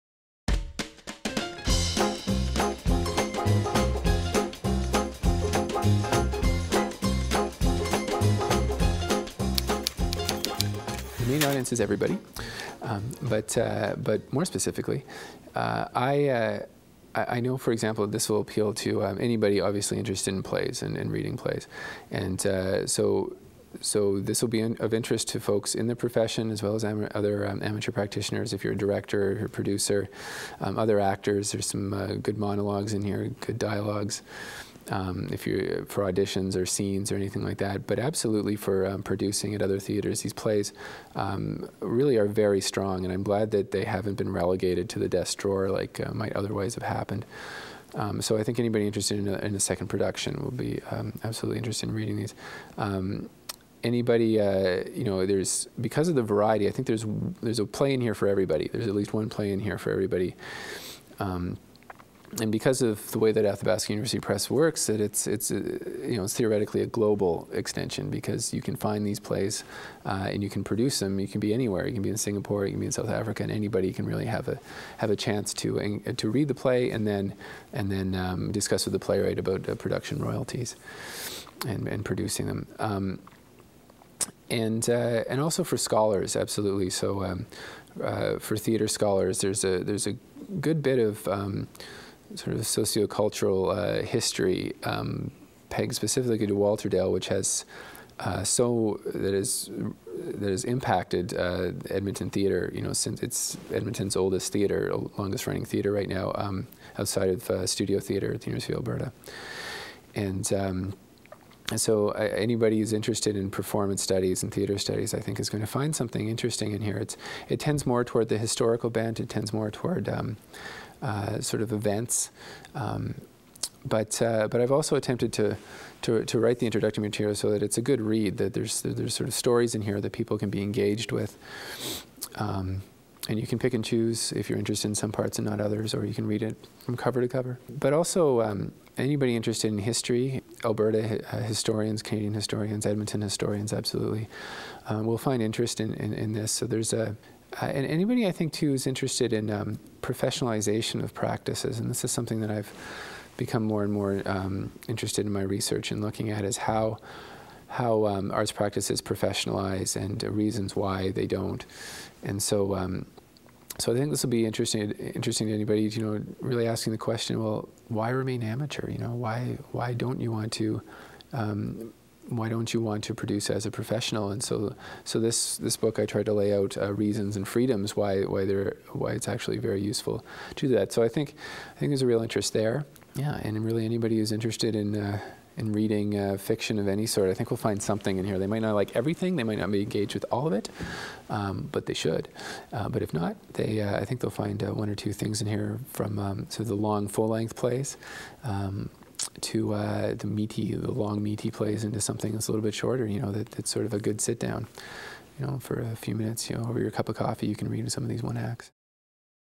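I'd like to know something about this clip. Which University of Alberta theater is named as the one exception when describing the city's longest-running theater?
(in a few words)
Studio Theater.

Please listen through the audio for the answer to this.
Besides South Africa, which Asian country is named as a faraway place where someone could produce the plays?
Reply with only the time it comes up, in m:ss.
1:12.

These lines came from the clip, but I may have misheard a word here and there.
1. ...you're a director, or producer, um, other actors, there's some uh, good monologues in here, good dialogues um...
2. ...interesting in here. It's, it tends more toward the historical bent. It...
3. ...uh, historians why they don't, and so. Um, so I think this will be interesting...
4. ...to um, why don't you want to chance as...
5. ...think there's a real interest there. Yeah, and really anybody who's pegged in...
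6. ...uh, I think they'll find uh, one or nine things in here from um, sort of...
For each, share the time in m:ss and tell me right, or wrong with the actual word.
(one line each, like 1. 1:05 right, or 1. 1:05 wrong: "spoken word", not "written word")
1. 0:28 right
2. 1:56 right
3. 2:40 wrong: "reasons", not "historians"
4. 2:50 wrong: "produce", not "chance"
5. 3:01 wrong: "interested", not "pegged"
6. 3:13 wrong: "two", not "nine".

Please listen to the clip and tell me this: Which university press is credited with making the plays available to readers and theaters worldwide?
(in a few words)
Athabasca University Press.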